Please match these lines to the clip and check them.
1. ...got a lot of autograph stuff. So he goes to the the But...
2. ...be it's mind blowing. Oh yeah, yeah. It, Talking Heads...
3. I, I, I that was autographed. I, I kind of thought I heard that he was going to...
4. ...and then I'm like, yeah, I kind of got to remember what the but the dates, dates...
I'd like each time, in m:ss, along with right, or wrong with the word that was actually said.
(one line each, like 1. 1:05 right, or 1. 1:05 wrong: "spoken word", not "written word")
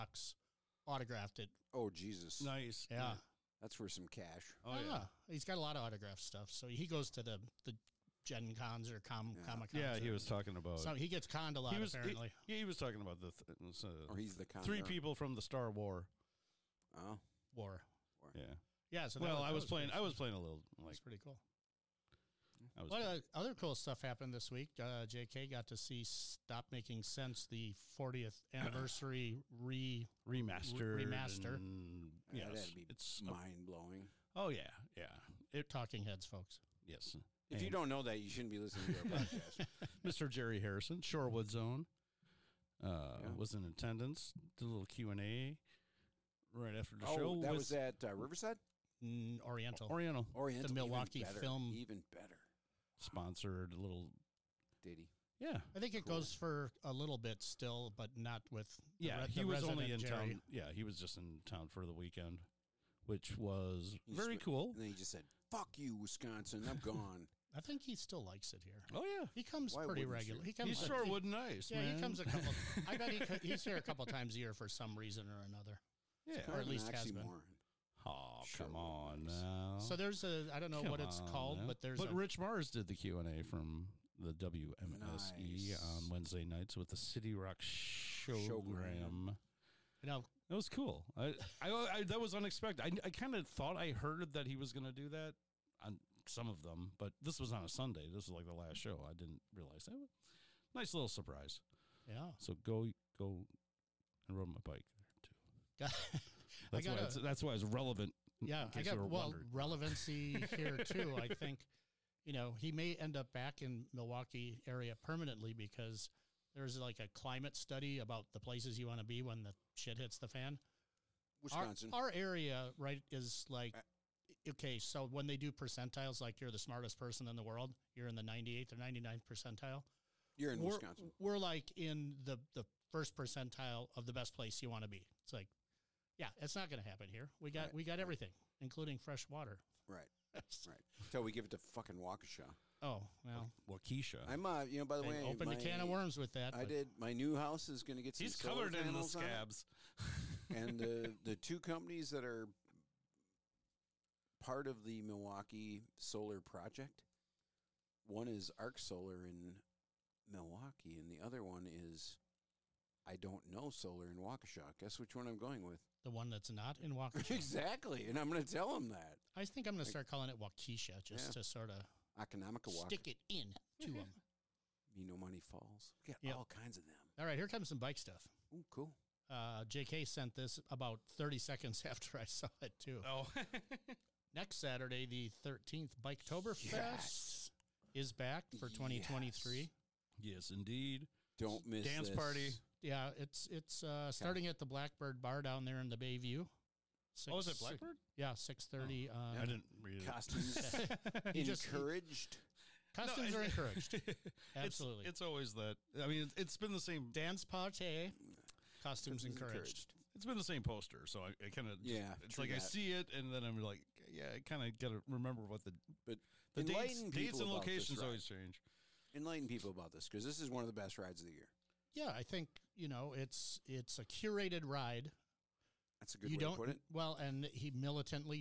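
1. 0:05 wrong: "Gen", not "But"
2. 0:32 right
3. 1:31 wrong: "unexpected", not "autographed"
4. 3:33 right.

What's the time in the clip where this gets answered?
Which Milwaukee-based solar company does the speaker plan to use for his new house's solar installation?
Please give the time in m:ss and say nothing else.
2:38.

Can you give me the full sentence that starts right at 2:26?
My new house is going to get.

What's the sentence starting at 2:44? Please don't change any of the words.
Guess which one I'm going with?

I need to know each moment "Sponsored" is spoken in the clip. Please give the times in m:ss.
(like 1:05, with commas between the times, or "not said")
0:52.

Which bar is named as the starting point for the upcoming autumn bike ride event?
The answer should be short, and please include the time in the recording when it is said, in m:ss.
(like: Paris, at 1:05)
Blackbird Bar, at 3:14.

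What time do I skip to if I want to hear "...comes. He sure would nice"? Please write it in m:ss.
1:10.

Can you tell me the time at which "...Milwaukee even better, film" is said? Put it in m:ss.
0:50.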